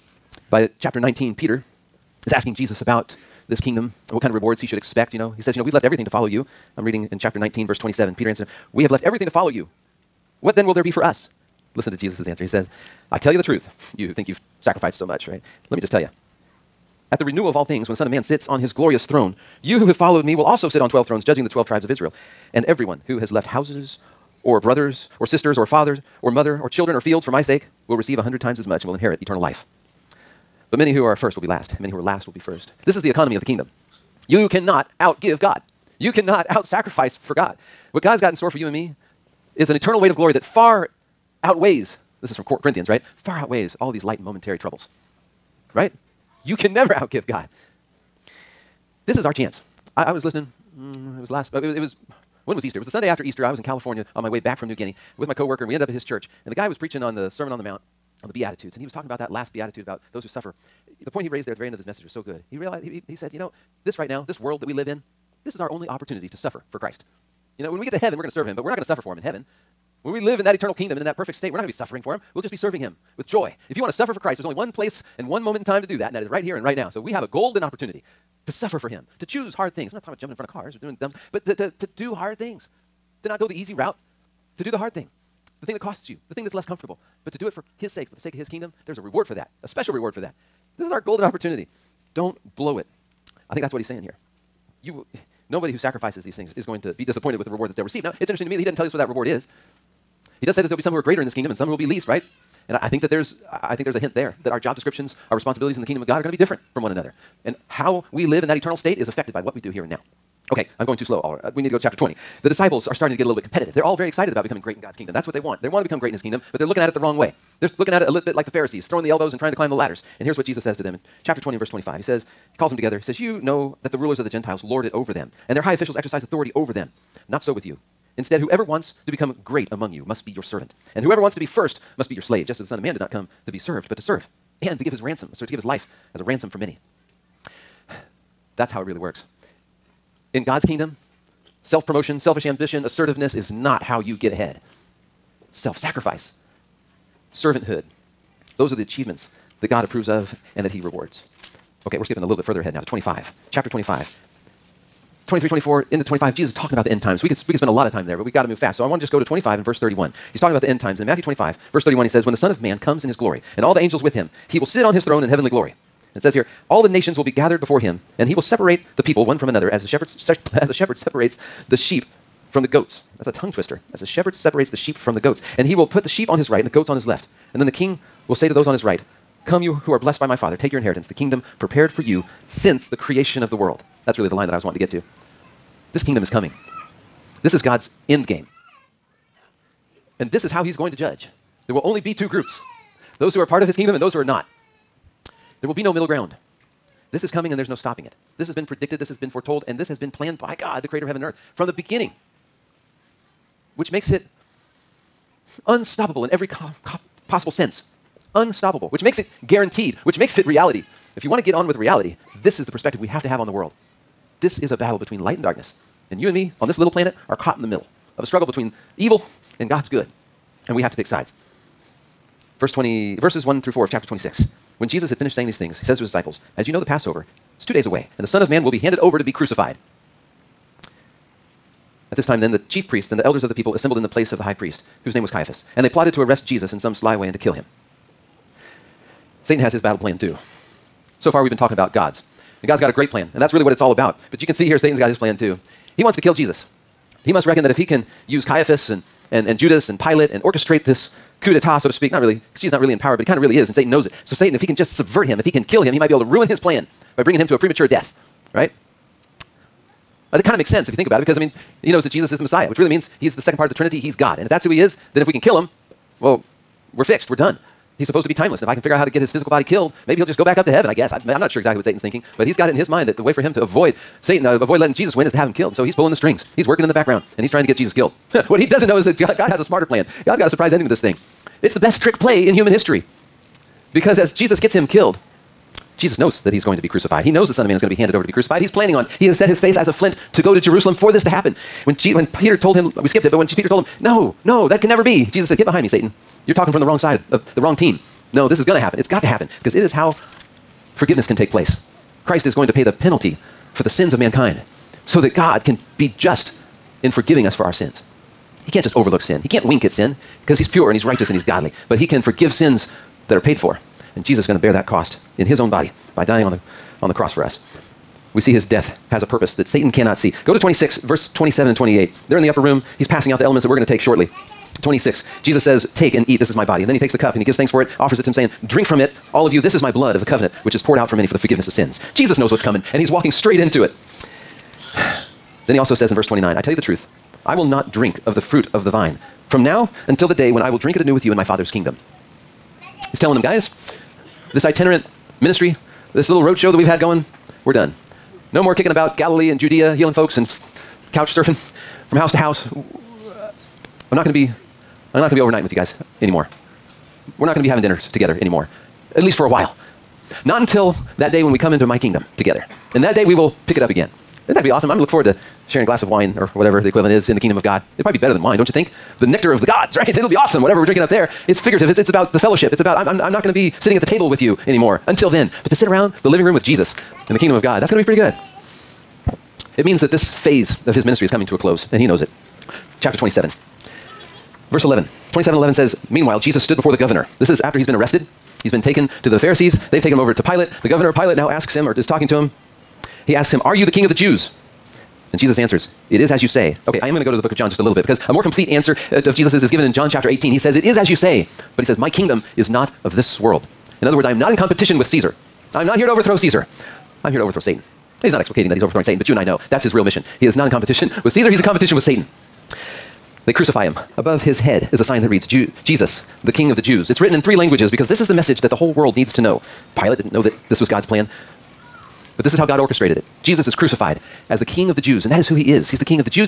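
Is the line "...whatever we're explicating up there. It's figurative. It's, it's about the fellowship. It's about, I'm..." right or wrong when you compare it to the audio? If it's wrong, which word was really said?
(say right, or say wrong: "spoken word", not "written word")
wrong: "drinking", not "explicating".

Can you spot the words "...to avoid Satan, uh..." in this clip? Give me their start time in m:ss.
4:33.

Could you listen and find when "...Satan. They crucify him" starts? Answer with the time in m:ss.
6:52.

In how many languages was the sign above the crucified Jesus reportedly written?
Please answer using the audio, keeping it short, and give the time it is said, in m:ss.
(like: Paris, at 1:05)
3, at 6:57.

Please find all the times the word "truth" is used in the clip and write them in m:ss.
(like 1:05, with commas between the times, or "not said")
0:13, 5:36.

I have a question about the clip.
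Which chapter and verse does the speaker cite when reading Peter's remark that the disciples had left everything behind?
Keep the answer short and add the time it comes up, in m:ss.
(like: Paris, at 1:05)
Chapter 19, verse 27, at 0:07.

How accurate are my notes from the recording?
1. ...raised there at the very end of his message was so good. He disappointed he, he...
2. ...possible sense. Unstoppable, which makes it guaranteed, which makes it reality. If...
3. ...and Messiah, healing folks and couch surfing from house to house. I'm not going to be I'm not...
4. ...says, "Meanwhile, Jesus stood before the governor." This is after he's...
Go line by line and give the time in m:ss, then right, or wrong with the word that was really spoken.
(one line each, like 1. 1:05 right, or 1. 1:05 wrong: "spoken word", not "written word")
1. 1:01 wrong: "realized", not "disappointed"
2. 3:27 right
3. 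5:49 wrong: "Judea", not "Messiah"
4. 6:25 right.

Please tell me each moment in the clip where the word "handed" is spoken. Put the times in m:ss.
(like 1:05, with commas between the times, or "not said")
3:48, 4:47.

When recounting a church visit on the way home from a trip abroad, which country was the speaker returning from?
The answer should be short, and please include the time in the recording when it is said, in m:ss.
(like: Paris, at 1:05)
New Guinea, at 0:54.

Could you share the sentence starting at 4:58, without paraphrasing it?
It's got to happen because it is how forgiveness can take place.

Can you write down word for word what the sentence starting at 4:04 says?
But you can see here, Satan's got his plan too.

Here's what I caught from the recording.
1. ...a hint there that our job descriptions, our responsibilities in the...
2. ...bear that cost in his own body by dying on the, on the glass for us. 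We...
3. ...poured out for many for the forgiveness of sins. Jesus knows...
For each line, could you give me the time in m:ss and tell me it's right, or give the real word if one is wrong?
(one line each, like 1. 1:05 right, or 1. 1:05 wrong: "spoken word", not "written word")
1. 1:43 right
2. 5:14 wrong: "cross", not "glass"
3. 5:30 right.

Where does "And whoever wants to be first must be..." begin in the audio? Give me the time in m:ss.
2:10.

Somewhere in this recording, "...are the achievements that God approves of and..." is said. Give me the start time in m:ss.
2:28.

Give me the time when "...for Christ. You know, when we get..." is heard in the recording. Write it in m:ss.
1:06.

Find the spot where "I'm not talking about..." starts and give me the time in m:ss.
1:19.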